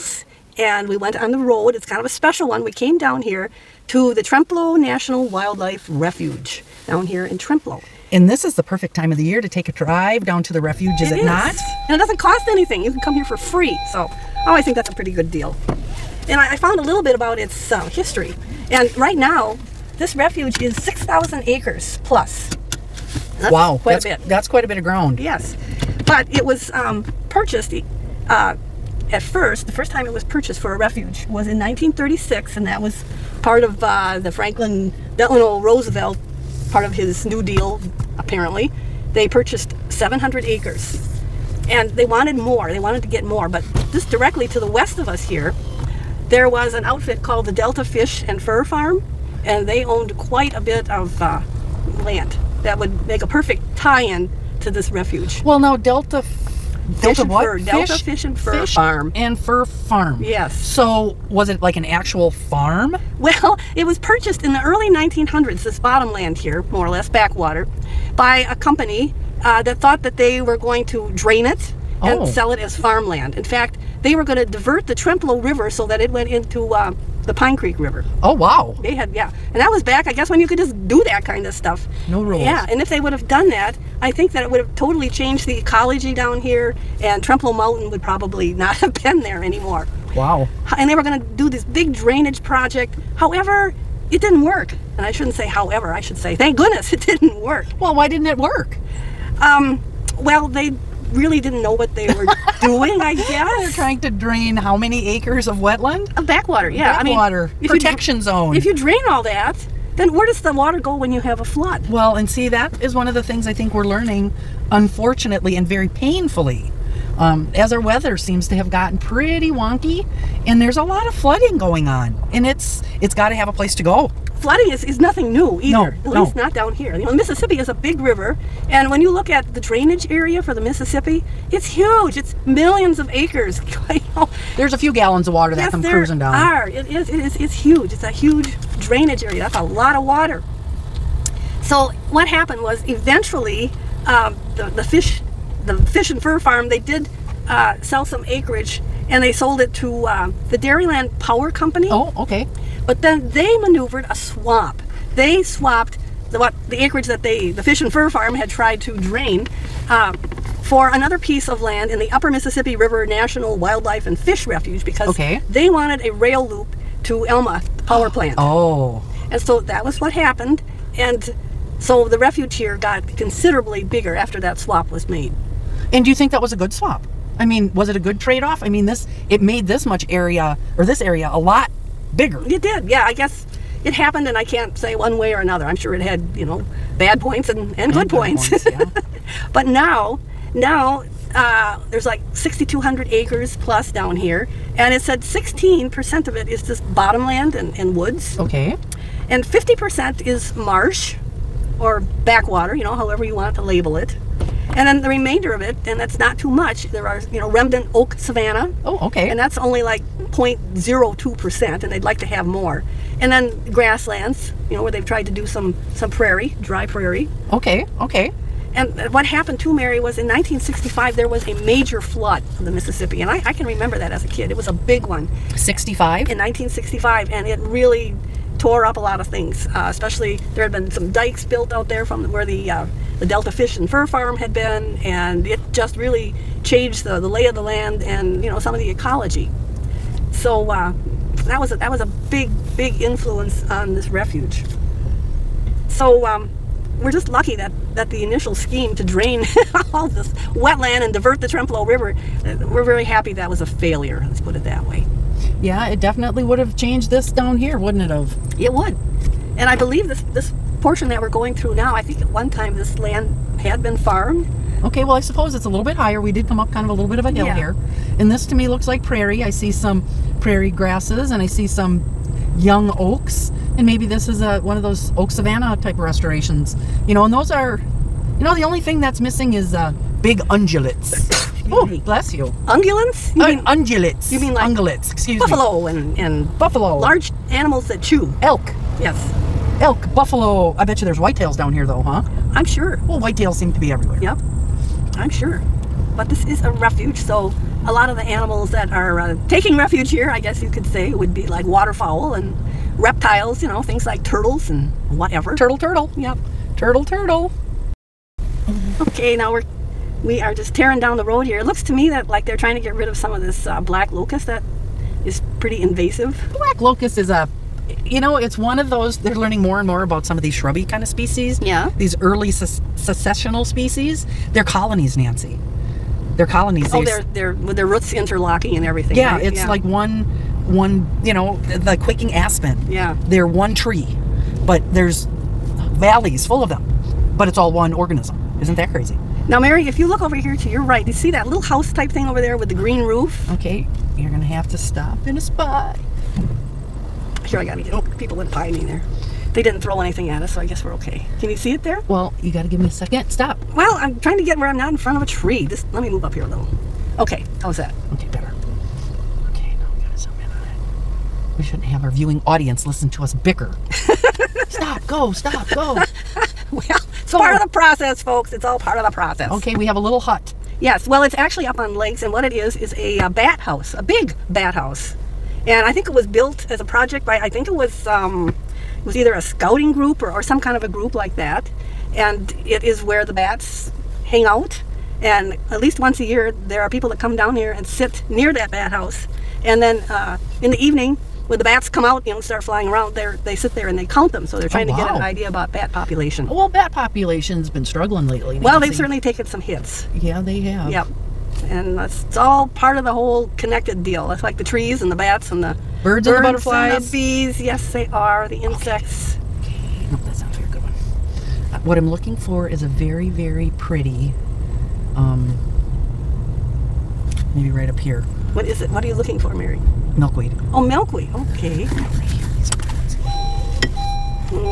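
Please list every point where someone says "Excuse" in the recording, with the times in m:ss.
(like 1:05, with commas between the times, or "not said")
4:45.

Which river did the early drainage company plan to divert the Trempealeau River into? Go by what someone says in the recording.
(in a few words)
Pine Creek River.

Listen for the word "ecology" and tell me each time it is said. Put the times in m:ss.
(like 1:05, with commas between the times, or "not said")
1:25, 3:58.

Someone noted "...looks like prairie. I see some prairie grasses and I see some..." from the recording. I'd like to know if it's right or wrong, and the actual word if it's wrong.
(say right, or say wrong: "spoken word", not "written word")
right.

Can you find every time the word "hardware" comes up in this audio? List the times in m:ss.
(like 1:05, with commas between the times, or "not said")
not said.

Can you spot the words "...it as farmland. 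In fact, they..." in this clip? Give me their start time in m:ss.
1:12.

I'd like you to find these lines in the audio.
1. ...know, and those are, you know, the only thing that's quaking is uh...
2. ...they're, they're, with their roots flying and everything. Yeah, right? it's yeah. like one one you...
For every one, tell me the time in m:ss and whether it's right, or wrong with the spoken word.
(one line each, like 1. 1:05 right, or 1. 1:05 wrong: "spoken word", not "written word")
1. 4:37 wrong: "missing", not "quaking"
2. 5:27 wrong: "interlocking", not "flying".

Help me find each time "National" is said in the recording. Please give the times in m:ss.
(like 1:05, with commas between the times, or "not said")
0:04, 2:43.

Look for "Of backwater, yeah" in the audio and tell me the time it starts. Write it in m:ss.
1:46.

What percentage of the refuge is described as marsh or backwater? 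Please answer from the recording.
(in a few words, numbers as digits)
50%.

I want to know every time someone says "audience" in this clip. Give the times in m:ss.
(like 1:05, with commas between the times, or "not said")
6:02.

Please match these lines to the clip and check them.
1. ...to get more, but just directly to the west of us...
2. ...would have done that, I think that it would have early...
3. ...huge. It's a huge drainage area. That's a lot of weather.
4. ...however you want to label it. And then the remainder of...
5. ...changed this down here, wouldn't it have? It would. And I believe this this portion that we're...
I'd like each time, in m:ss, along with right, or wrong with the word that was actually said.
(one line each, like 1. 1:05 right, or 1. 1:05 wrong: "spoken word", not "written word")
1. 0:43 right
2. 1:22 wrong: "totally", not "early"
3. 2:17 wrong: "water", not "weather"
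4. 3:22 right
5. 4:16 right.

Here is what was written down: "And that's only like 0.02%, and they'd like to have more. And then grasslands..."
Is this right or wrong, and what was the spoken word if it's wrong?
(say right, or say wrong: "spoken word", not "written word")
right.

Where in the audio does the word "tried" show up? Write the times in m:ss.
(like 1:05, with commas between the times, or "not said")
2:38, 3:35.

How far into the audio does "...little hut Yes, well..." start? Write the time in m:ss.
6:09.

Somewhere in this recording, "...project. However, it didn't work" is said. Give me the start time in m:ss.
1:32.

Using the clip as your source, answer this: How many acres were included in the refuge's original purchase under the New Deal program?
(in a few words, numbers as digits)
700.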